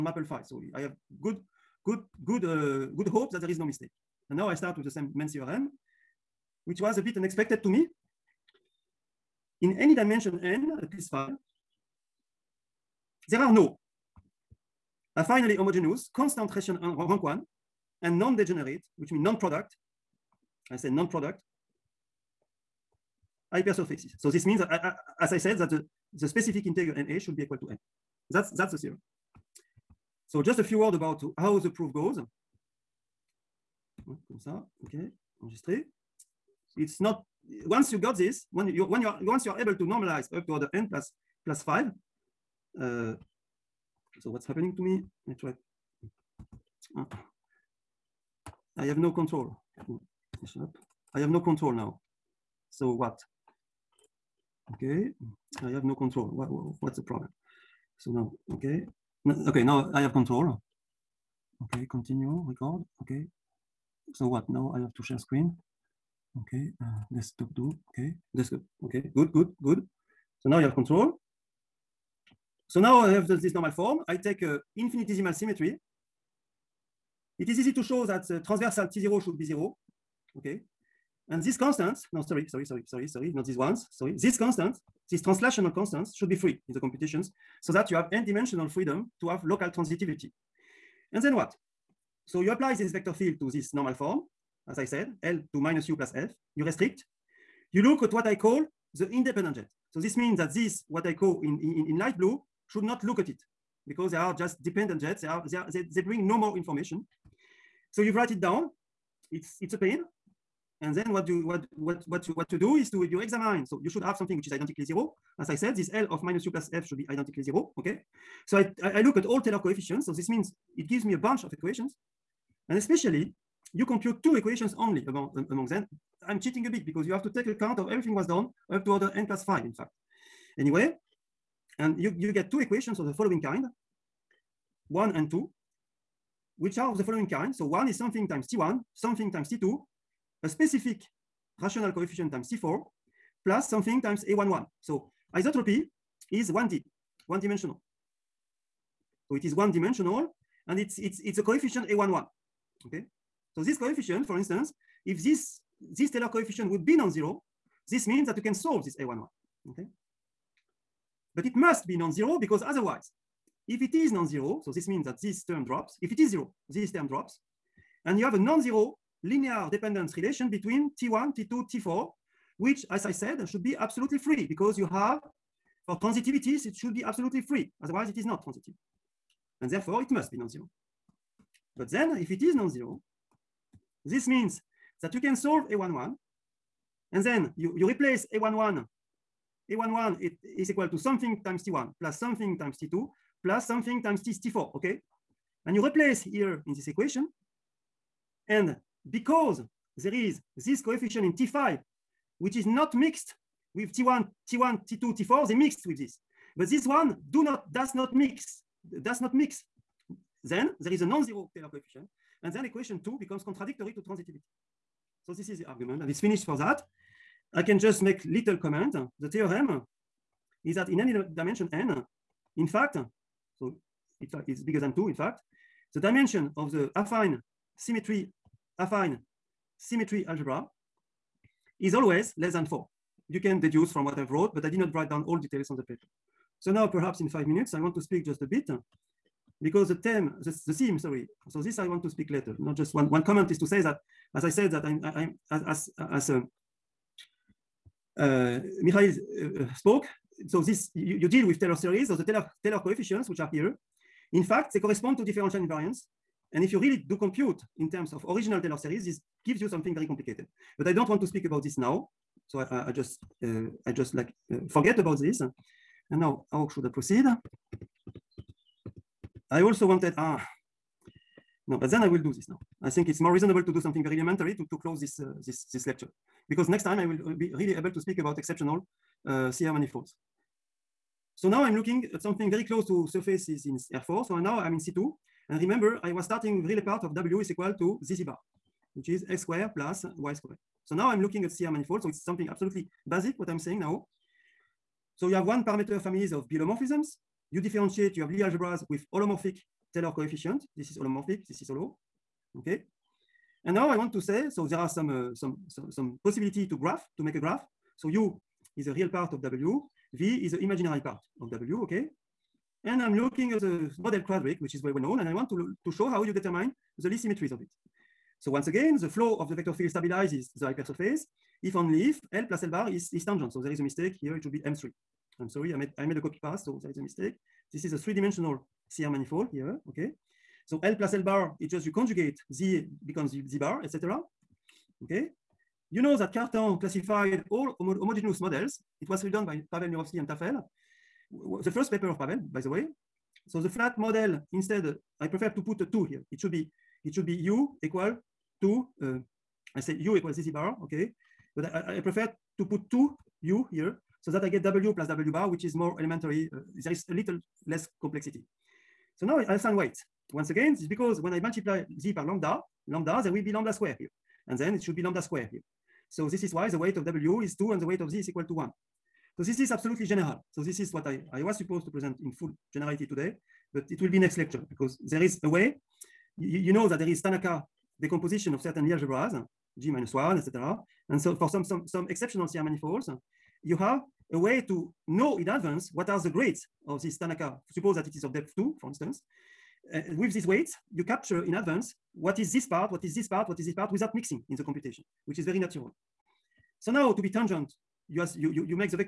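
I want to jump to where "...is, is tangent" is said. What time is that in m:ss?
5:22.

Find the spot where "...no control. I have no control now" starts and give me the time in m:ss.
0:48.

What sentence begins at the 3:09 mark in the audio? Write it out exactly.
A11 it is equal to something times T1 plus something times T2 plus something times T, T4, okay?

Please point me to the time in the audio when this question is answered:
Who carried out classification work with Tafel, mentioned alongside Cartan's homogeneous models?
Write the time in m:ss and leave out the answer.
5:39.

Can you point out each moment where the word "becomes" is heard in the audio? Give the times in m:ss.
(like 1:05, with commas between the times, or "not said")
3:33, 5:33.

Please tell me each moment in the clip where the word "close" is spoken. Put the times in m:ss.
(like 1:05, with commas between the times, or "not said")
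4:34, 4:42.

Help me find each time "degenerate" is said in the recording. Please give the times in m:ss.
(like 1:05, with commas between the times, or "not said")
0:18.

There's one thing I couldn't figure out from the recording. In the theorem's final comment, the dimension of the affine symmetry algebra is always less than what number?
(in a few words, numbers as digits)
4.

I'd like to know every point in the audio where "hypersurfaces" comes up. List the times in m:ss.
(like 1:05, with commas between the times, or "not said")
0:23, 5:20.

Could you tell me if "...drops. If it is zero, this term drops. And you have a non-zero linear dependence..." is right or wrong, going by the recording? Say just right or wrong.
right.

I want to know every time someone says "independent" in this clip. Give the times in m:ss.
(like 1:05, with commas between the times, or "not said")
1:39.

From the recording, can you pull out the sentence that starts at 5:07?
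So U is a real part of W, V is the imaginary part of W, okay?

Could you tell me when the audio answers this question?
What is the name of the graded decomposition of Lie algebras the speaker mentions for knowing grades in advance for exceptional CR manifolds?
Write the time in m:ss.
6:17.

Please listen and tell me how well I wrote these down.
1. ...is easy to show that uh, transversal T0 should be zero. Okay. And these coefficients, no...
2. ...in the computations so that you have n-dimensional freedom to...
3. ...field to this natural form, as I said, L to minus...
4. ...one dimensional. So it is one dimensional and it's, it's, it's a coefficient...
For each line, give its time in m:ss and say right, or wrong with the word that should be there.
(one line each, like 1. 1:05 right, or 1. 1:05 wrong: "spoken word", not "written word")
1. 1:17 wrong: "constants", not "coefficients"
2. 1:26 right
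3. 1:33 wrong: "normal", not "natural"
4. 2:27 right.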